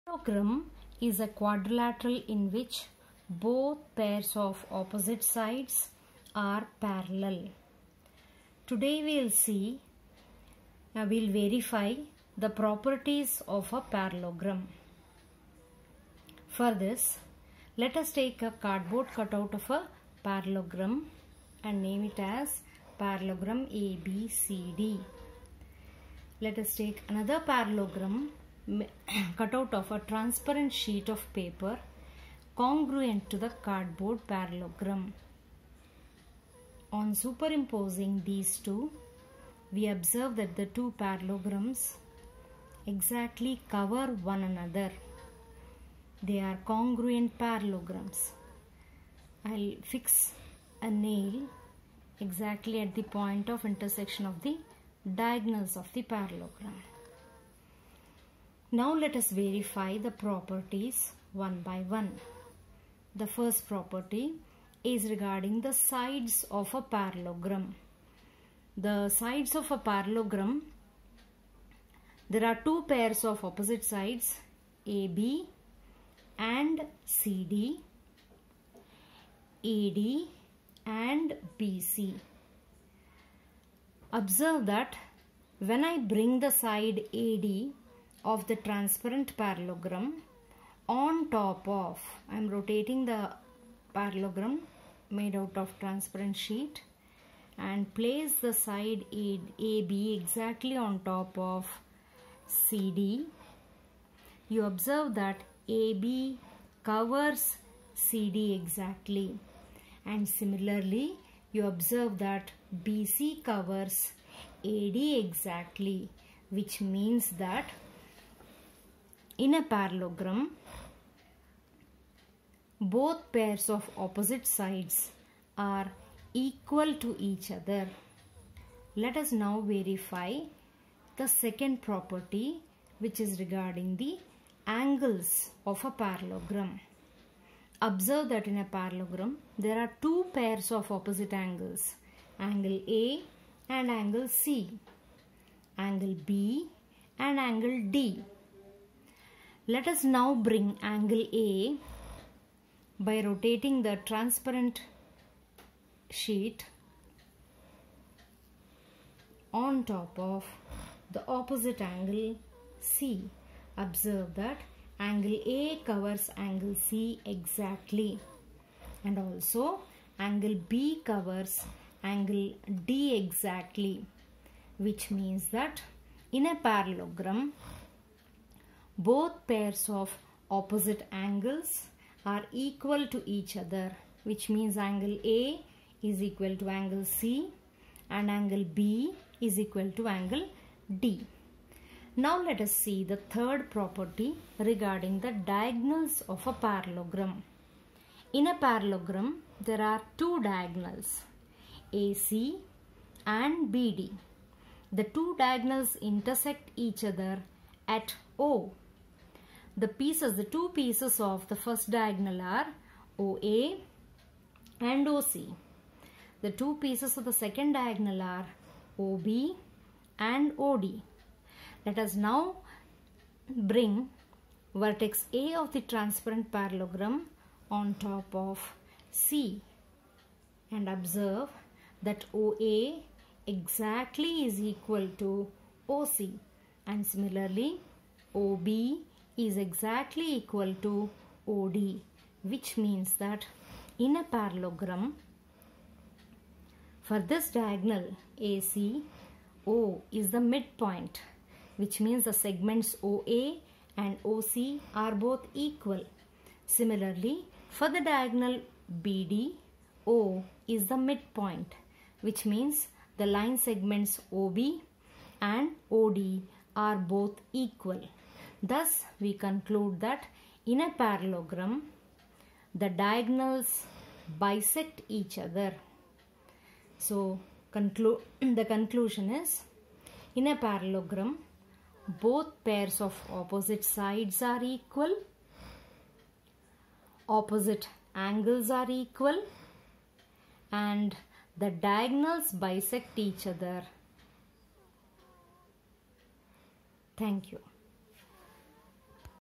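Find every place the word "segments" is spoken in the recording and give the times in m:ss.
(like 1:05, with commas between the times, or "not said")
4:12, 4:23.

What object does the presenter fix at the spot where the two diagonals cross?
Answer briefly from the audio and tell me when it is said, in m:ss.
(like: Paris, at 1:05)
A nail, at 0:50.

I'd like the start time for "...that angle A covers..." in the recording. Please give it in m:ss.
2:44.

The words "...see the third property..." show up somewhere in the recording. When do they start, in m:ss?
3:12.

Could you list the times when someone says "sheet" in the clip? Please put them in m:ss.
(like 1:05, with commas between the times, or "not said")
0:30, 1:36, 2:36.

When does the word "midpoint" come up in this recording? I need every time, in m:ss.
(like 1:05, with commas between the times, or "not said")
4:10, 4:20.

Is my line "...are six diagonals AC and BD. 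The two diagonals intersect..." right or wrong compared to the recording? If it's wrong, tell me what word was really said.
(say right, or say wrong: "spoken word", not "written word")
wrong: "two", not "six".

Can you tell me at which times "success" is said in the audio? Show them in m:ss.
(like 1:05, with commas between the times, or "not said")
not said.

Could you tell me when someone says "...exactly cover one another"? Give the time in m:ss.
0:42.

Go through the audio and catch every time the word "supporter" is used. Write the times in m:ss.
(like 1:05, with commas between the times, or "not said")
not said.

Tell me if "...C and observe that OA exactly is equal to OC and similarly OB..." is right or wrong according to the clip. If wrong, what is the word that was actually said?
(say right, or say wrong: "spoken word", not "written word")
right.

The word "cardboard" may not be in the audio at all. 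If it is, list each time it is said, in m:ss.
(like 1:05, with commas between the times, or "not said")
0:18, 0:33.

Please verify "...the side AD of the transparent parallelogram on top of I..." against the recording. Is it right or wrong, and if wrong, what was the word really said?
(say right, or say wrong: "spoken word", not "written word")
right.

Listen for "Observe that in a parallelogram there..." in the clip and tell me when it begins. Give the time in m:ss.
2:17.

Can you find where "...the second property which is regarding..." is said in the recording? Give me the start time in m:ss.
2:11.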